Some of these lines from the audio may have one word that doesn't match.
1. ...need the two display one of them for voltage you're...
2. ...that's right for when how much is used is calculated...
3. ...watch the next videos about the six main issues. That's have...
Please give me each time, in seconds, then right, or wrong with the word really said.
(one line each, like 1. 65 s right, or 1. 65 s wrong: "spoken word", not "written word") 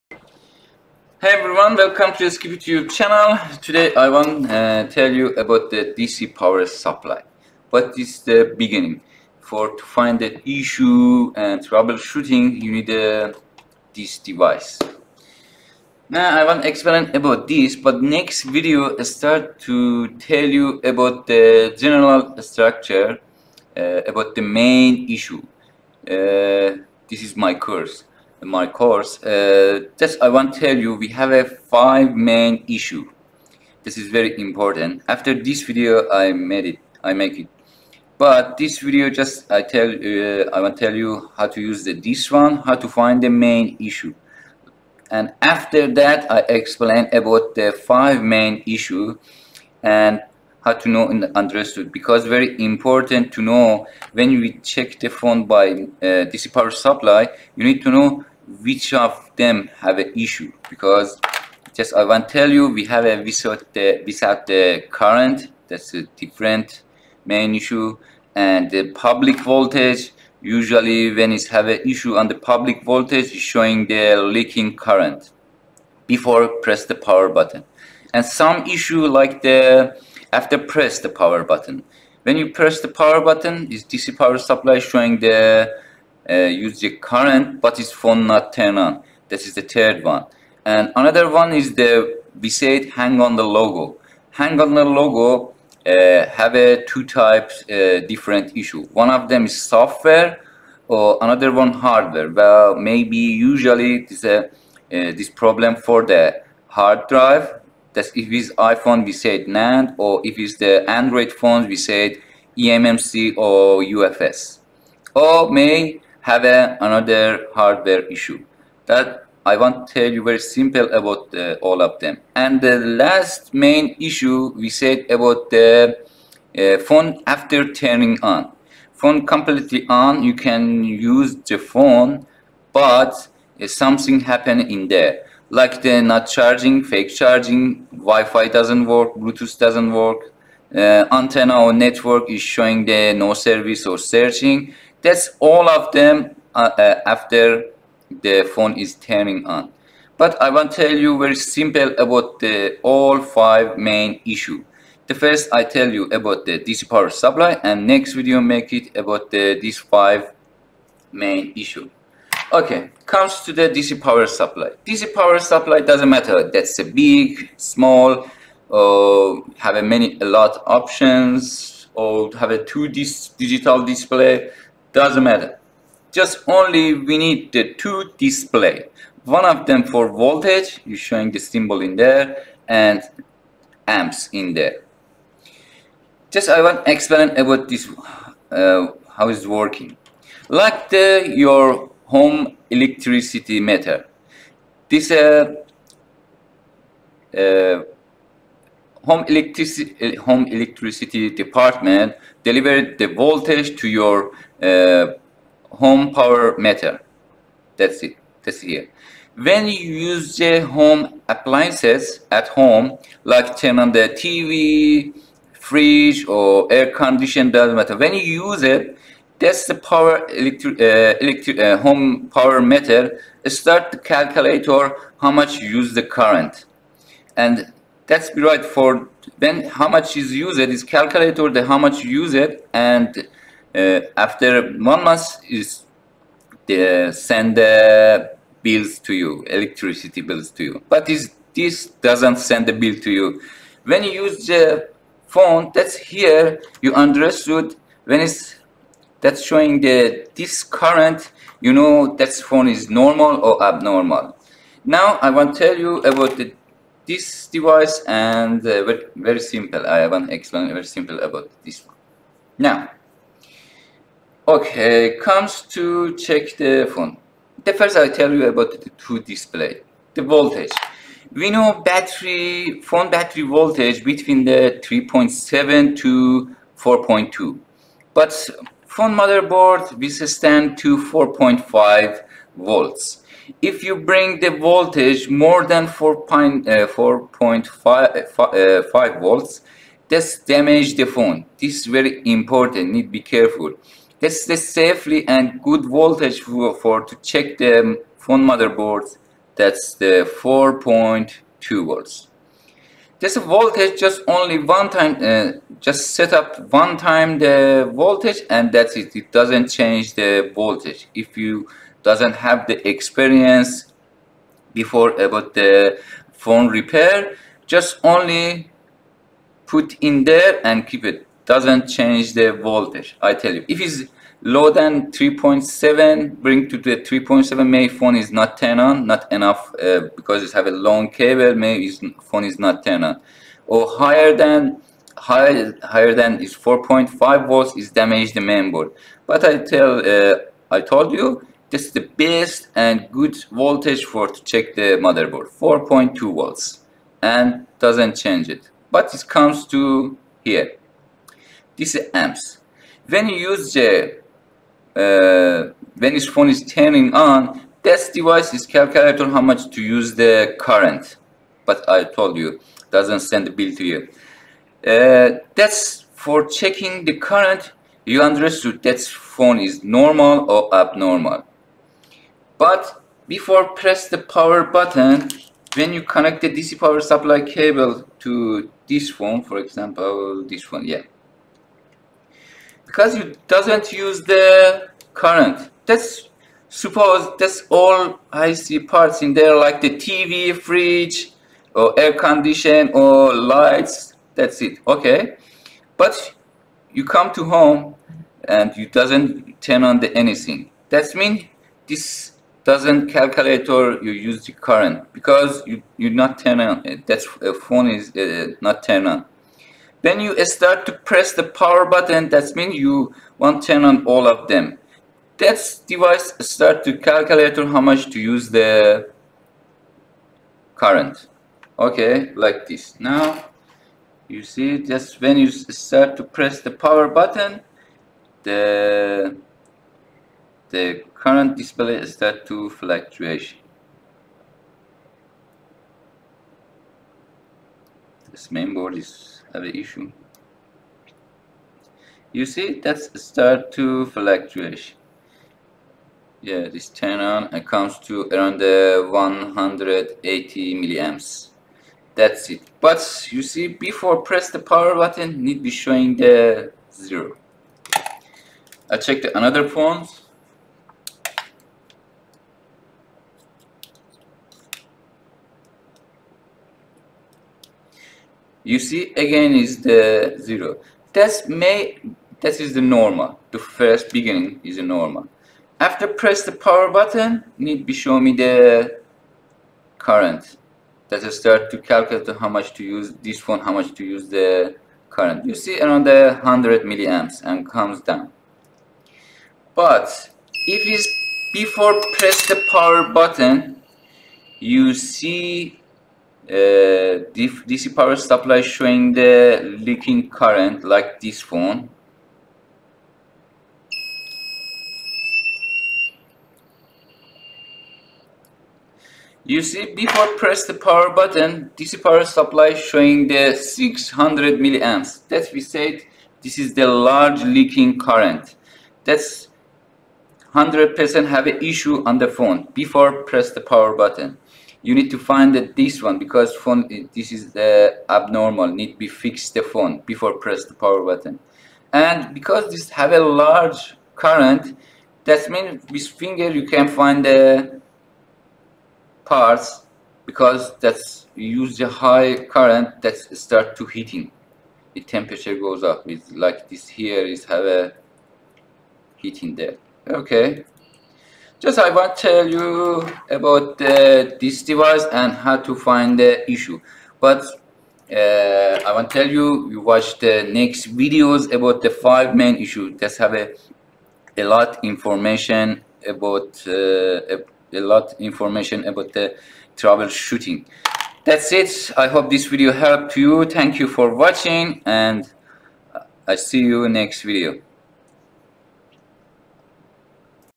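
1. 177 s right
2. 228 s right
3. 559 s wrong: "five", not "six".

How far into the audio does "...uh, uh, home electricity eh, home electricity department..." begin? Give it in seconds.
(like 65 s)
195 s.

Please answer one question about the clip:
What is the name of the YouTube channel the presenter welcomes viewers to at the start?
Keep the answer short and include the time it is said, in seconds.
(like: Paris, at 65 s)
SkippyTube, at 2 s.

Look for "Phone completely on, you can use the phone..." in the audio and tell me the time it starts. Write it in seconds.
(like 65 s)
128 s.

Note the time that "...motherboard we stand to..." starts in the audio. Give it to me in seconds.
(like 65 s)
279 s.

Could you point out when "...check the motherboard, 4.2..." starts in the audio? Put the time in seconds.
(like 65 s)
344 s.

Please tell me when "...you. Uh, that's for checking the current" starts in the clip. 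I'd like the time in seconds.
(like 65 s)
363 s.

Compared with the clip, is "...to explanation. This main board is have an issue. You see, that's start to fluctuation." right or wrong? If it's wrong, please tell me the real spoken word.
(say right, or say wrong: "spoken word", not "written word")
wrong: "fluctuation", not "explanation".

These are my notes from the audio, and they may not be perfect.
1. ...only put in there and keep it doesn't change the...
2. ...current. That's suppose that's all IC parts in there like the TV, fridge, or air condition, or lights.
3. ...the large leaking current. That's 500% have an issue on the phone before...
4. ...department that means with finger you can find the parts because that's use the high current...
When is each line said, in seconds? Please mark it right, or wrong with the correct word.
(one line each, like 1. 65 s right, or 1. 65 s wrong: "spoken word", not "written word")
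1. 318 s right
2. 385 s right
3. 516 s wrong: "100", not "500"
4. 534 s wrong: "current", not "department".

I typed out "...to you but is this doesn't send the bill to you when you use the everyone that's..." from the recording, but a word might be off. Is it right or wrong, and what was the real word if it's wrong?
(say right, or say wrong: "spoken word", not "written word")
wrong: "phone", not "everyone".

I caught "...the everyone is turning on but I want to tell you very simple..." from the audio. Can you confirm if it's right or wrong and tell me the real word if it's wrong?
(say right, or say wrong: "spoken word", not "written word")
wrong: "phone", not "everyone".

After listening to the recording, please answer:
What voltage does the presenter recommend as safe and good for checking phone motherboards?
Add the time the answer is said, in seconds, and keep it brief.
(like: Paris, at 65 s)
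4.2 volts, at 300 s.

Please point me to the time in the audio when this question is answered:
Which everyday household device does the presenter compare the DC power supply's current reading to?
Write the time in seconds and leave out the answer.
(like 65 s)
192 s.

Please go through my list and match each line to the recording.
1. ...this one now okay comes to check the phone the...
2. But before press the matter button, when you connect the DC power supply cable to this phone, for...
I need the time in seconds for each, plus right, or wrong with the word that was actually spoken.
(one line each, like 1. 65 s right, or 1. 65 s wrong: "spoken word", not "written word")
1. 261 s right
2. 372 s wrong: "power", not "matter".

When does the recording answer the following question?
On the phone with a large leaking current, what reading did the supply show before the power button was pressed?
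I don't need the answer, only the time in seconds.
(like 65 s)
513 s.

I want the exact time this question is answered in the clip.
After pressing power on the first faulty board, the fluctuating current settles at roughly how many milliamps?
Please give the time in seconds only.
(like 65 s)
449 s.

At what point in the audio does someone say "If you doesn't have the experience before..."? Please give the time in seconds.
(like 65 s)
311 s.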